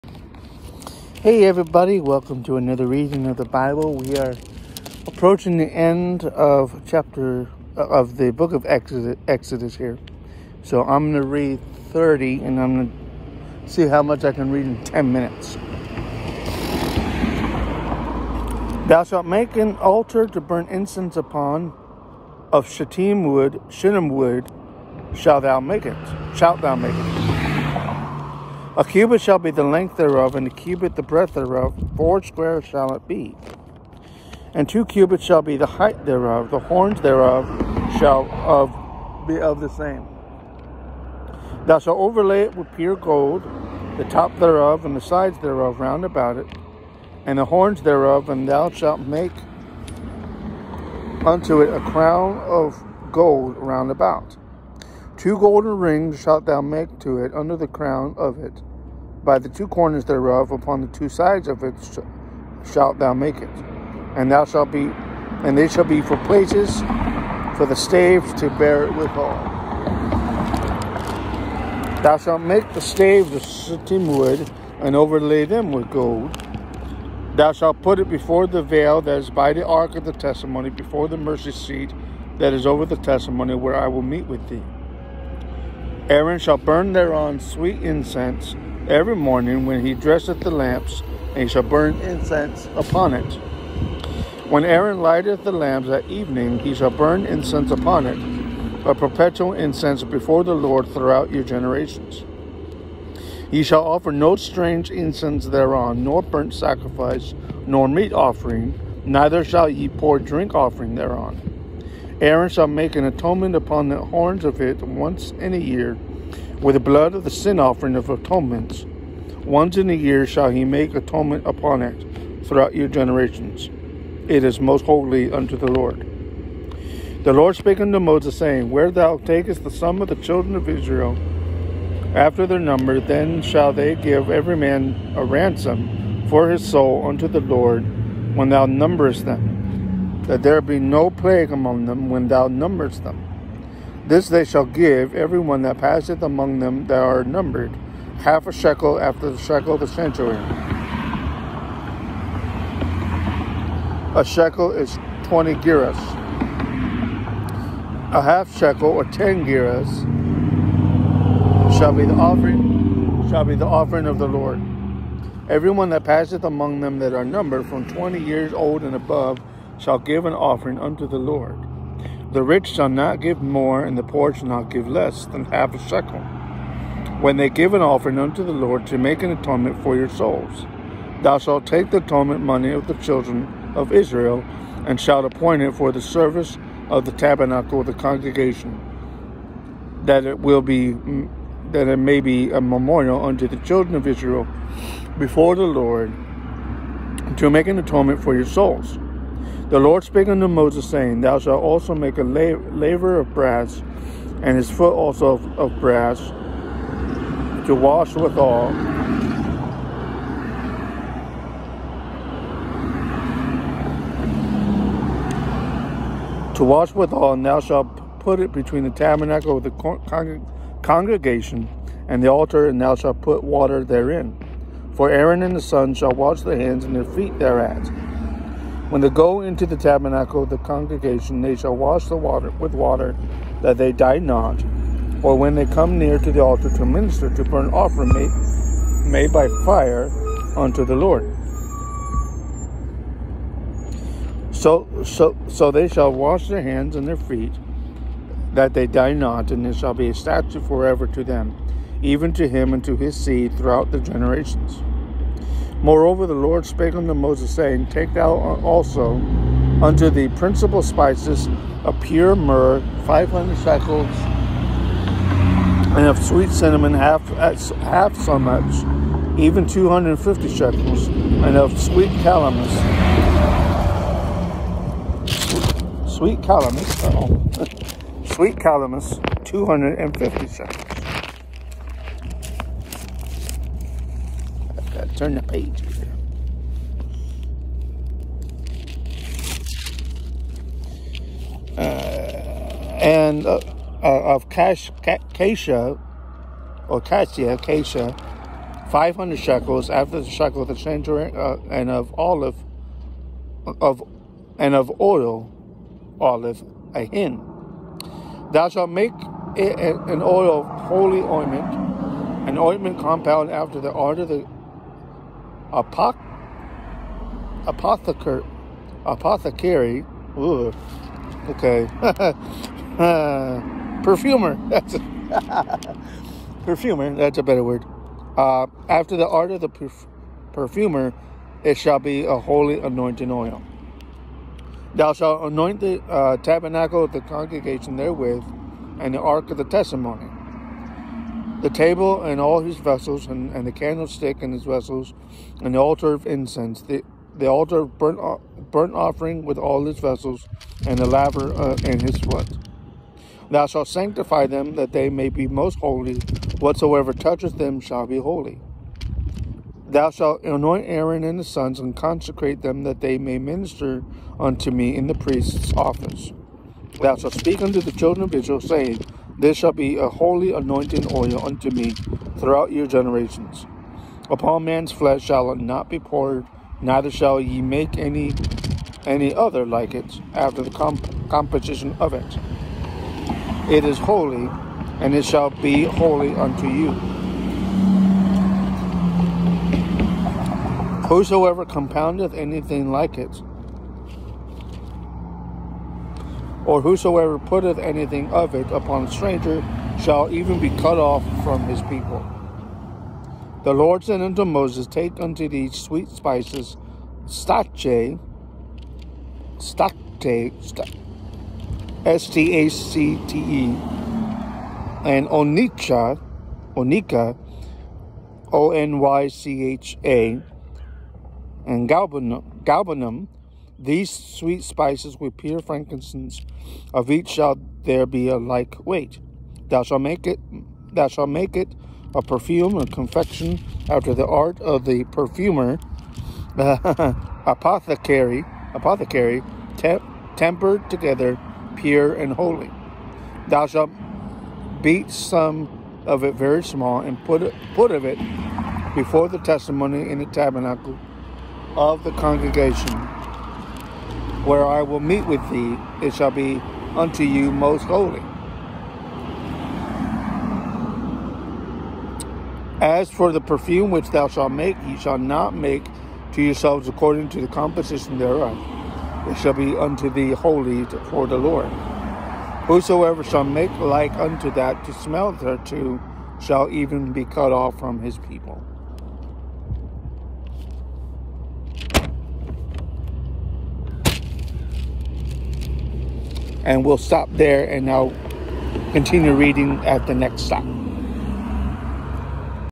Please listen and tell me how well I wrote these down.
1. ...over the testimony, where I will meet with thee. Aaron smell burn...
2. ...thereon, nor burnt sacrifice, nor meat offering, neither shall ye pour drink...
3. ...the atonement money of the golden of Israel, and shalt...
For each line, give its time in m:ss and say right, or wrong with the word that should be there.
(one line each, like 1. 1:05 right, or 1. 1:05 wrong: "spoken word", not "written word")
1. 1:22 wrong: "shall", not "smell"
2. 1:45 right
3. 3:01 wrong: "children", not "golden".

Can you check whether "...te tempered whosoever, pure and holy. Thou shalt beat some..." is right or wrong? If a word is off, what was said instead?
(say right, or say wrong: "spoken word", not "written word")
wrong: "together", not "whosoever".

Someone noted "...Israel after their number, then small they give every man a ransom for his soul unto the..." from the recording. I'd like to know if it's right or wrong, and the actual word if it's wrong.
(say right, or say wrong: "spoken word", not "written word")
wrong: "shall", not "small".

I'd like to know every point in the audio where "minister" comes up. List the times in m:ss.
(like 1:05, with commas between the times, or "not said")
3:56, 6:03.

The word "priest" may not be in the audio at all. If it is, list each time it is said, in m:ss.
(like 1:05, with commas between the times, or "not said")
6:05.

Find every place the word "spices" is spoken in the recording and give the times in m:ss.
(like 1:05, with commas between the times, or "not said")
4:20, 6:46, 7:04.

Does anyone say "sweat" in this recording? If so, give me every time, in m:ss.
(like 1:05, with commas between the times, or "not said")
5:52.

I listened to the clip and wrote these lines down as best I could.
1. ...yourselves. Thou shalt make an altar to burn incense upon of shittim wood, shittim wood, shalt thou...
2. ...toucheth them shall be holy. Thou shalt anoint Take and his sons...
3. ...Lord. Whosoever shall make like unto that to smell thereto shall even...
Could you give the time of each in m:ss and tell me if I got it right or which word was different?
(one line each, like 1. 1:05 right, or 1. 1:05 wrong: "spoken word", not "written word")
1. 0:15 wrong: "minutes", not "yourselves"
2. 5:57 wrong: "Aaron", not "Take"
3. 7:51 right.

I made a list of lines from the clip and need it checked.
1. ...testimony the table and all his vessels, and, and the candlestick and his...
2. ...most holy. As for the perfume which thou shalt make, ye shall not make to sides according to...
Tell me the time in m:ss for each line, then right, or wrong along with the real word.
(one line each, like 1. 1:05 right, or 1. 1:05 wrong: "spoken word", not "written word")
1. 5:39 right
2. 7:37 wrong: "yourselves", not "sides".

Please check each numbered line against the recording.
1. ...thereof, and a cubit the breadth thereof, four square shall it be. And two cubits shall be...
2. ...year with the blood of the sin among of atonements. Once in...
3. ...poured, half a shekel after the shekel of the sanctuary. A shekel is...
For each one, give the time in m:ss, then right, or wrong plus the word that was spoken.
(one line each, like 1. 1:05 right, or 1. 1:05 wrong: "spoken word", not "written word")
1. 0:29 right
2. 1:55 wrong: "offering", not "among"
3. 2:27 wrong: "numbered", not "poured".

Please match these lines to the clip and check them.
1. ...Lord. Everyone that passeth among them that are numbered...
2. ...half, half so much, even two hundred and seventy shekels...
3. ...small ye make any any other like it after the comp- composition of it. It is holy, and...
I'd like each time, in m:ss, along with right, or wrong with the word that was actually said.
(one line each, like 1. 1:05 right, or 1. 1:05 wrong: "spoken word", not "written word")
1. 2:44 right
2. 4:26 wrong: "fifty", not "seventy"
3. 6:17 wrong: "shall", not "small".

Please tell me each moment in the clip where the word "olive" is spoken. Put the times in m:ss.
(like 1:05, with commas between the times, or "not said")
5:02, 5:06.